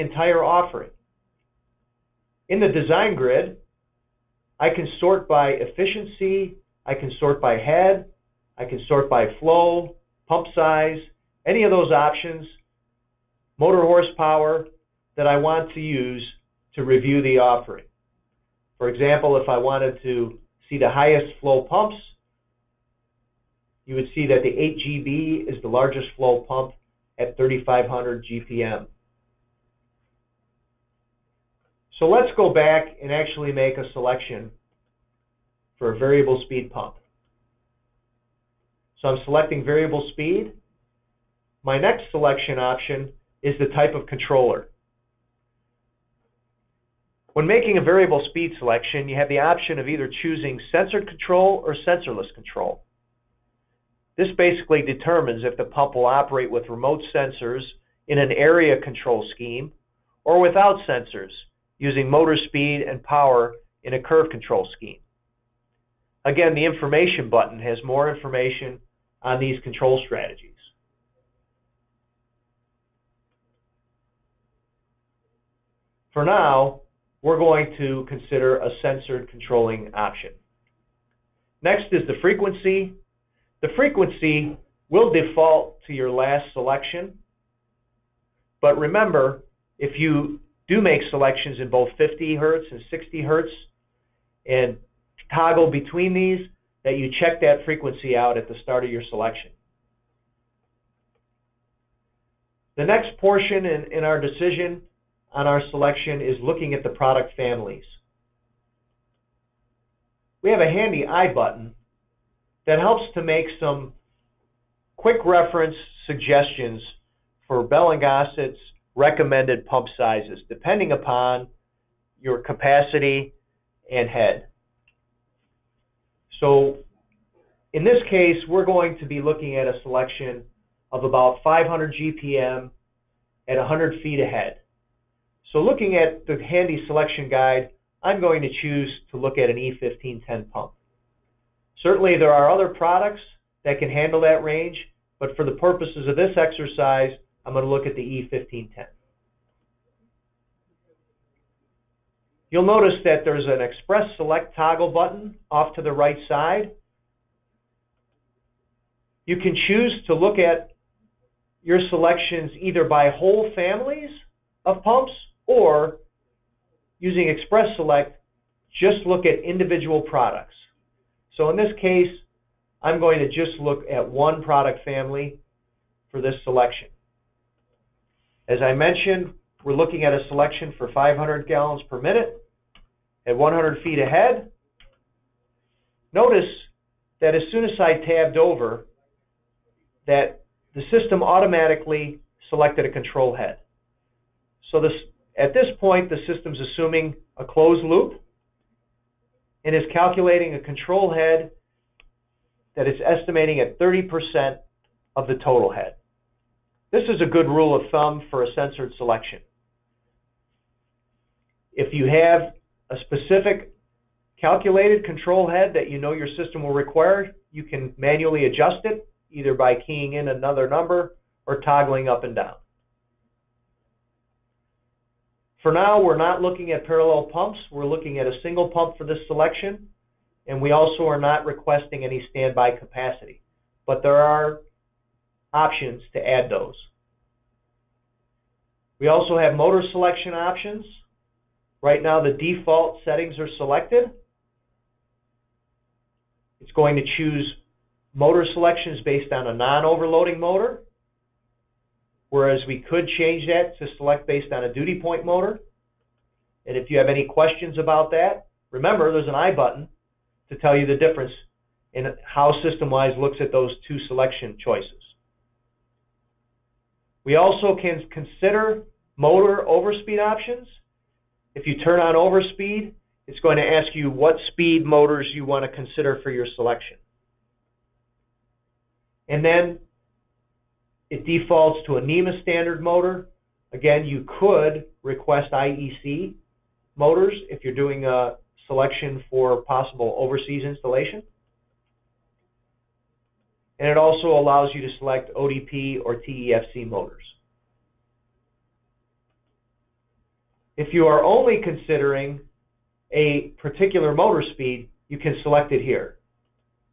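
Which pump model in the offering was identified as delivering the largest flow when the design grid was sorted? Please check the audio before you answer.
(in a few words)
8 GB.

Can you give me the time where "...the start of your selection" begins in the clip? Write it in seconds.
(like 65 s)
98 s.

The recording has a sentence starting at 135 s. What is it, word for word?
So looking at the handy selection guide, I'm going to choose to look at an E1510 pump.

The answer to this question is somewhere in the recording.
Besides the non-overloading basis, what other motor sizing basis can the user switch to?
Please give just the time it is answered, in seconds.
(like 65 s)
254 s.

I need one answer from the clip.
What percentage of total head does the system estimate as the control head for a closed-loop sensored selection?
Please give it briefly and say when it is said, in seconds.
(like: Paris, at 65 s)
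30%, at 203 s.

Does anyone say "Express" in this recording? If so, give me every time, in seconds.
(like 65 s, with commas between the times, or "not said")
153 s, 167 s.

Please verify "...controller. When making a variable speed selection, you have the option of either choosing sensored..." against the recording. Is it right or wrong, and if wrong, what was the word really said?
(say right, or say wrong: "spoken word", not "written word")
right.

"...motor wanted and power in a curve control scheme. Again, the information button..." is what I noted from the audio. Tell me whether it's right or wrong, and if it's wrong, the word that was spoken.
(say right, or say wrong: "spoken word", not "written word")
wrong: "speed", not "wanted".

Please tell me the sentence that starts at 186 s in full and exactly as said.
Notice that as soon as I tabbed over, that the system automatically selected a control head.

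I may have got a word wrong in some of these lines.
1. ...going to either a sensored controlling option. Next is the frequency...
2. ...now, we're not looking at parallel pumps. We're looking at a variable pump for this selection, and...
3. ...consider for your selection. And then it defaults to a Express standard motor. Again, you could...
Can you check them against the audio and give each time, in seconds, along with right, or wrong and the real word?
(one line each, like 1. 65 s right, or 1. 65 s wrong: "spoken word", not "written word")
1. 77 s wrong: "consider", not "either"
2. 225 s wrong: "single", not "variable"
3. 275 s wrong: "NEMA", not "Express".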